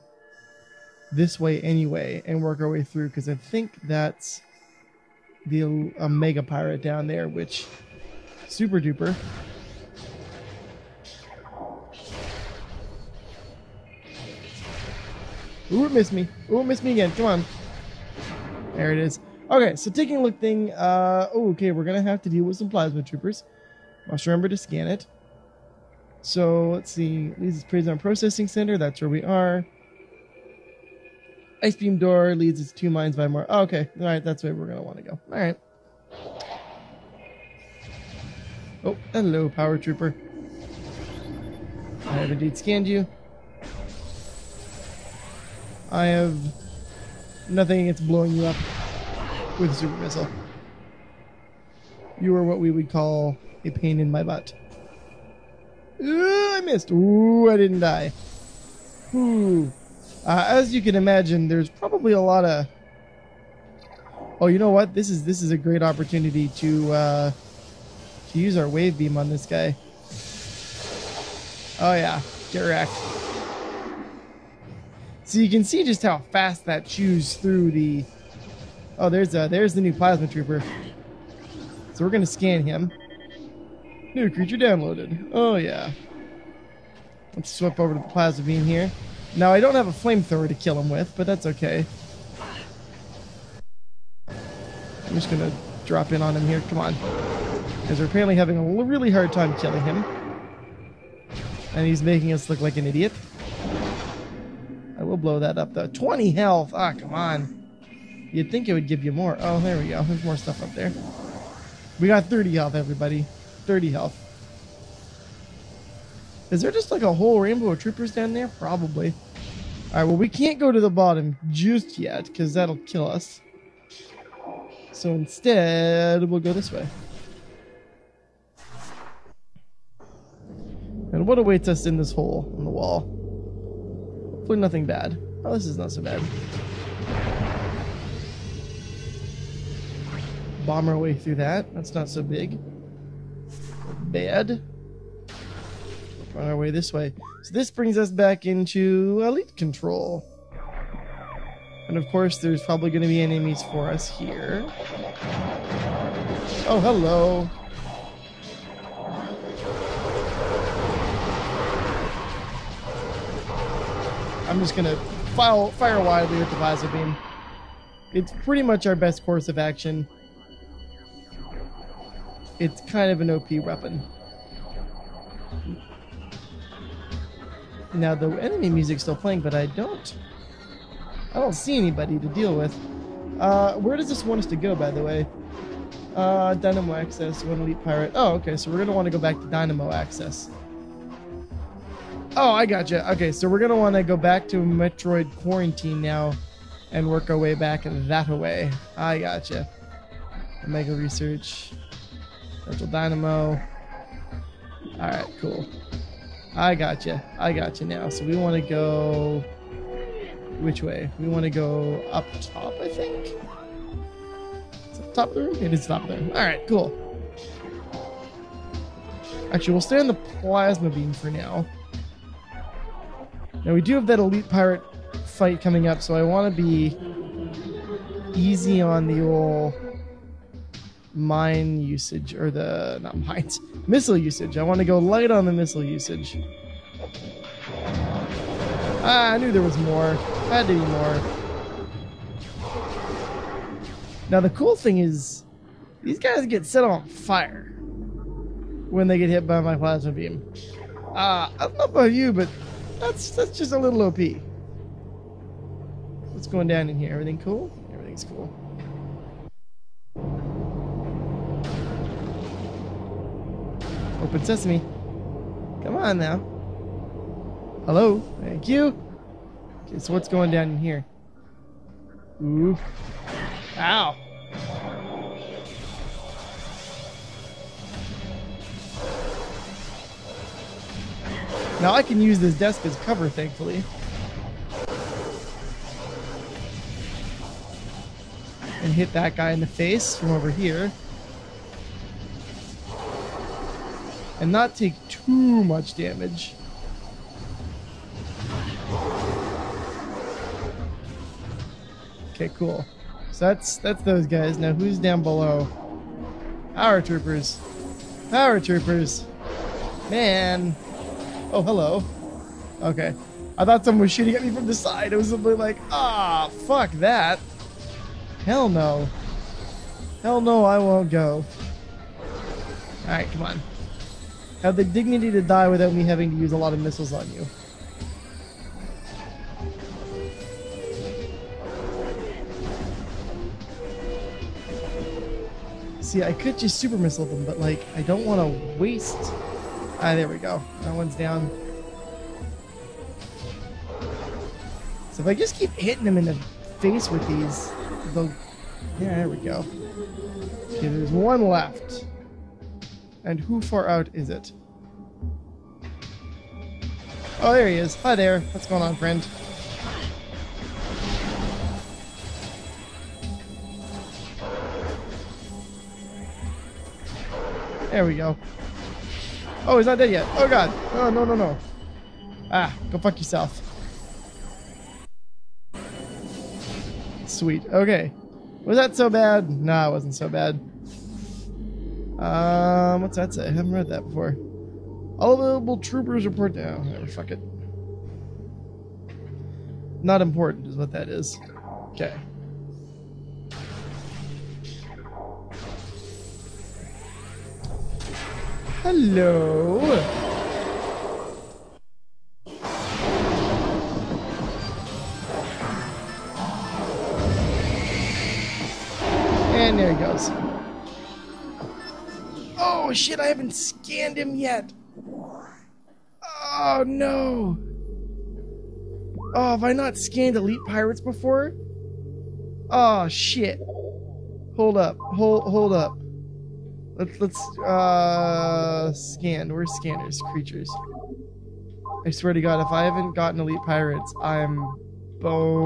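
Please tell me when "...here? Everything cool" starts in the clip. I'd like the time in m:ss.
4:16.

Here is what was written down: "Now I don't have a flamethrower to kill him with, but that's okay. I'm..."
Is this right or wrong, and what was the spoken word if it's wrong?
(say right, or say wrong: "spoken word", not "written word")
right.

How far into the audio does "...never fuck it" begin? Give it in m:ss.
6:26.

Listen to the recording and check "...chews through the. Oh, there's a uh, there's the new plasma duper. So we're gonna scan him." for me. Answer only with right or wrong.
wrong.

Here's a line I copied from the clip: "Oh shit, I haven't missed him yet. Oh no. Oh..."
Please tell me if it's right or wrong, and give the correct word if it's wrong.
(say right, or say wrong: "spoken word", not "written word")
wrong: "scanned", not "missed".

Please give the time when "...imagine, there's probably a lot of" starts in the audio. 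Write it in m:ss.
1:00.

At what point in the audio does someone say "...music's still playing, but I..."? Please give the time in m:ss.
2:58.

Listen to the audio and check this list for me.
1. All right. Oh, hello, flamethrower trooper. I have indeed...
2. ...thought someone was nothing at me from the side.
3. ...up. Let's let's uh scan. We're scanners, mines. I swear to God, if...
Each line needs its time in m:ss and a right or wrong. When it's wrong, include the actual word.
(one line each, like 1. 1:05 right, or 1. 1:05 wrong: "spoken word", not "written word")
1. 0:35 wrong: "power", not "flamethrower"
2. 5:13 wrong: "shooting", not "nothing"
3. 7:05 wrong: "creatures", not "mines".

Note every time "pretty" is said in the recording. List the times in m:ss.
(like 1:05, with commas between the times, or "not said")
2:48.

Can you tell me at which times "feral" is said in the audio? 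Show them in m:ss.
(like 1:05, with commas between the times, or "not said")
not said.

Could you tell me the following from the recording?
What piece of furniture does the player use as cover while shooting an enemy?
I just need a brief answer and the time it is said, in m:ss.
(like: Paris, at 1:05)
Desk, at 4:42.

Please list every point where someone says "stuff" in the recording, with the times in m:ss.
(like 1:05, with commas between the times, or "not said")
1:50.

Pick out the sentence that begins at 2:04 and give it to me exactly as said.
So instead, we'll go this way.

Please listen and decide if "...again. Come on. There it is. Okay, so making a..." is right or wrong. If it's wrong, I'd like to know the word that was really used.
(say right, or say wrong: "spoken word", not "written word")
wrong: "taking", not "making".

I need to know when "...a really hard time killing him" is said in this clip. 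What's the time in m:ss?
1:38.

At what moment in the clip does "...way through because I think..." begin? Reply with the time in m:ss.
0:02.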